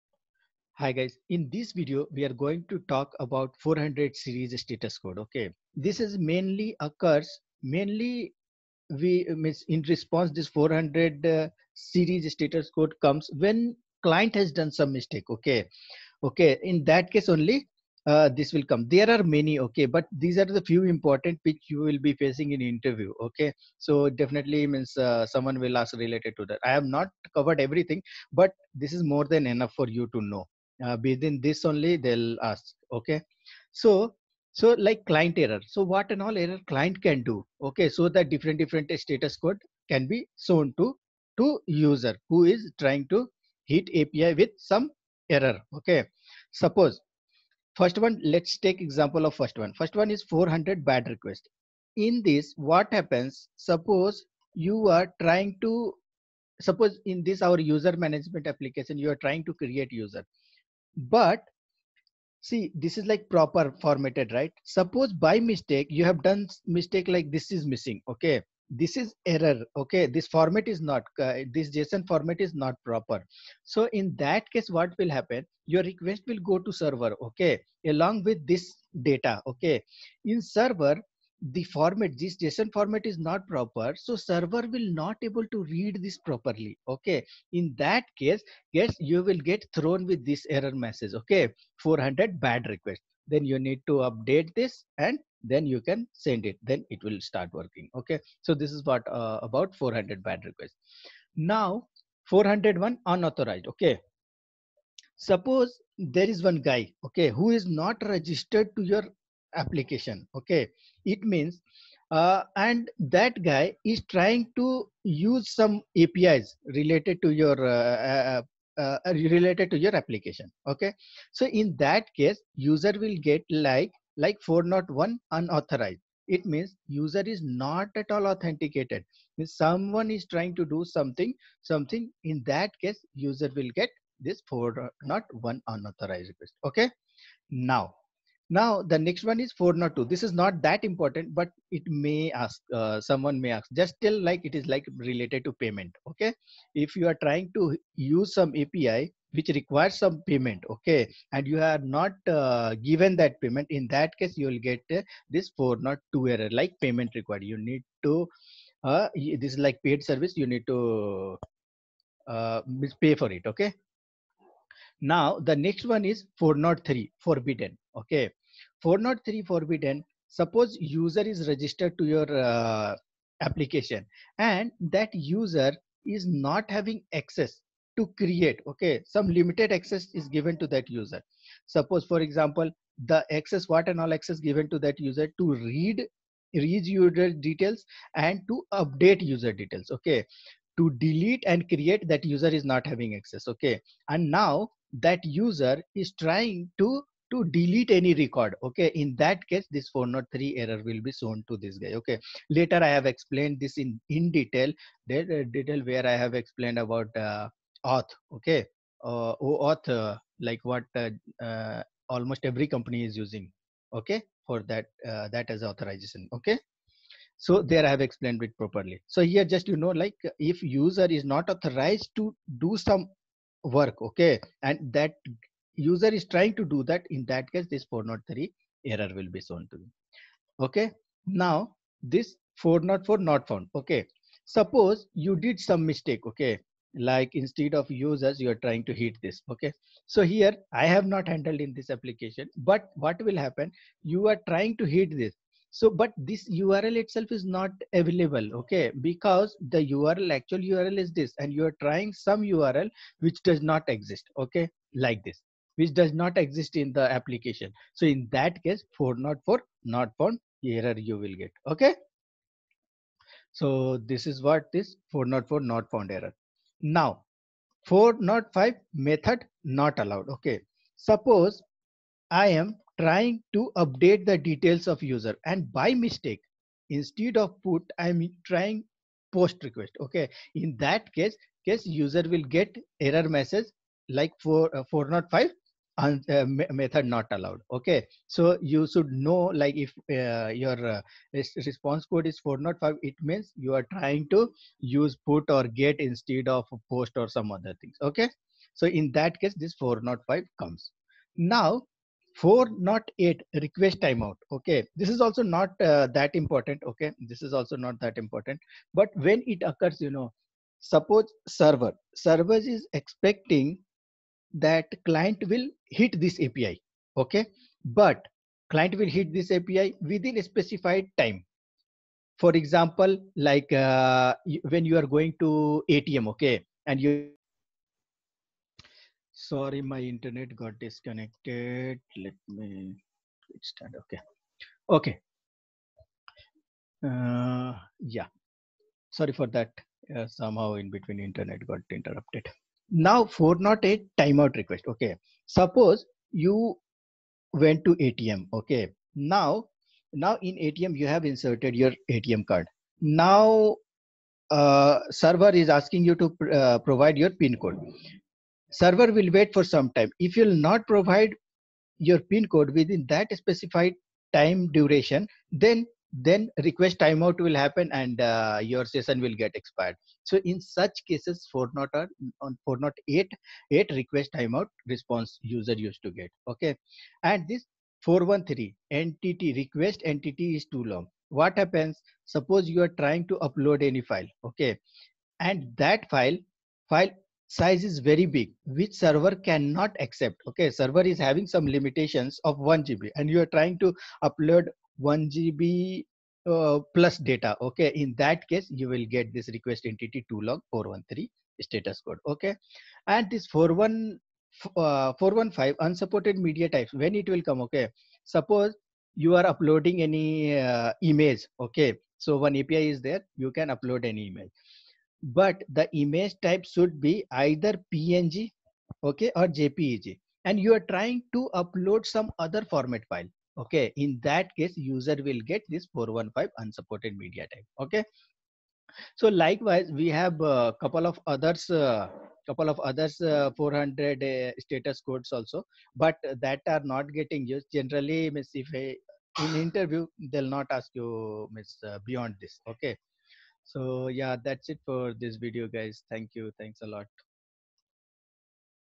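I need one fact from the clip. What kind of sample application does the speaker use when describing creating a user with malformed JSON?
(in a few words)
user management application.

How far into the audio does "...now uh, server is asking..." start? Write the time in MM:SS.
05:52.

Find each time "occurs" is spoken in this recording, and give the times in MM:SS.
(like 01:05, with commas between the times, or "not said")
00:06, 05:09.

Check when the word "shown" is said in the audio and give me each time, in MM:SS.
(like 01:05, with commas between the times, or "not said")
00:40, 03:21, 03:49.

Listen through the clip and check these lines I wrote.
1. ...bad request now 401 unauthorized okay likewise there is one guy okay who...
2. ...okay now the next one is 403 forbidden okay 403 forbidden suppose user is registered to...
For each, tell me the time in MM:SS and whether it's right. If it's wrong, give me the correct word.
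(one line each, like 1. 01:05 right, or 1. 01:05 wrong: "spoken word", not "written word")
1. 01:40 wrong: "suppose", not "likewise"
2. 02:43 right.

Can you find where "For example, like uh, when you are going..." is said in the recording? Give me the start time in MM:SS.
05:22.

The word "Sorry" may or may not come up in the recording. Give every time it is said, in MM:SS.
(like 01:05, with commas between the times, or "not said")
05:29, 05:39.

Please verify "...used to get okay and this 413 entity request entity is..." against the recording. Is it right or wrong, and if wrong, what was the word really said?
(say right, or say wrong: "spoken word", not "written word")
right.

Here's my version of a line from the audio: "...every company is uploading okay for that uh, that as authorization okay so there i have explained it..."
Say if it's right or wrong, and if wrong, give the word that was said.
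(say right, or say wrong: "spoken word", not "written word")
wrong: "using", not "uploading".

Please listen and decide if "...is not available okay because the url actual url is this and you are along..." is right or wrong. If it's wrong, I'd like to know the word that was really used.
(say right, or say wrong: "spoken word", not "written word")
wrong: "trying", not "along".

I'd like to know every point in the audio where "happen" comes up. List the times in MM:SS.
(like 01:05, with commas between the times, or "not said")
00:52, 01:15, 04:03, 06:07, 06:21.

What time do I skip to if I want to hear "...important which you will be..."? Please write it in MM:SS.
00:20.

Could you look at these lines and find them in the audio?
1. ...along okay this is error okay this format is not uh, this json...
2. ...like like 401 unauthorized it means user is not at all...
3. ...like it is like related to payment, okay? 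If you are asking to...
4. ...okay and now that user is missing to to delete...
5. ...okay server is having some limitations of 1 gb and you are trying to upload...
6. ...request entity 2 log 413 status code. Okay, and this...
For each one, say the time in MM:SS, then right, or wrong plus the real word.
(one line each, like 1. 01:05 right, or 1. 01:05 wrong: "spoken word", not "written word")
1. 01:07 wrong: "missing", not "along"
2. 02:03 right
3. 02:24 wrong: "trying", not "asking"
4. 03:13 wrong: "trying", not "missing"
5. 06:30 right
6. 06:39 right.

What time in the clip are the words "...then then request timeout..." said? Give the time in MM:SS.
06:05.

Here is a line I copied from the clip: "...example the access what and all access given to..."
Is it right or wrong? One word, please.
right.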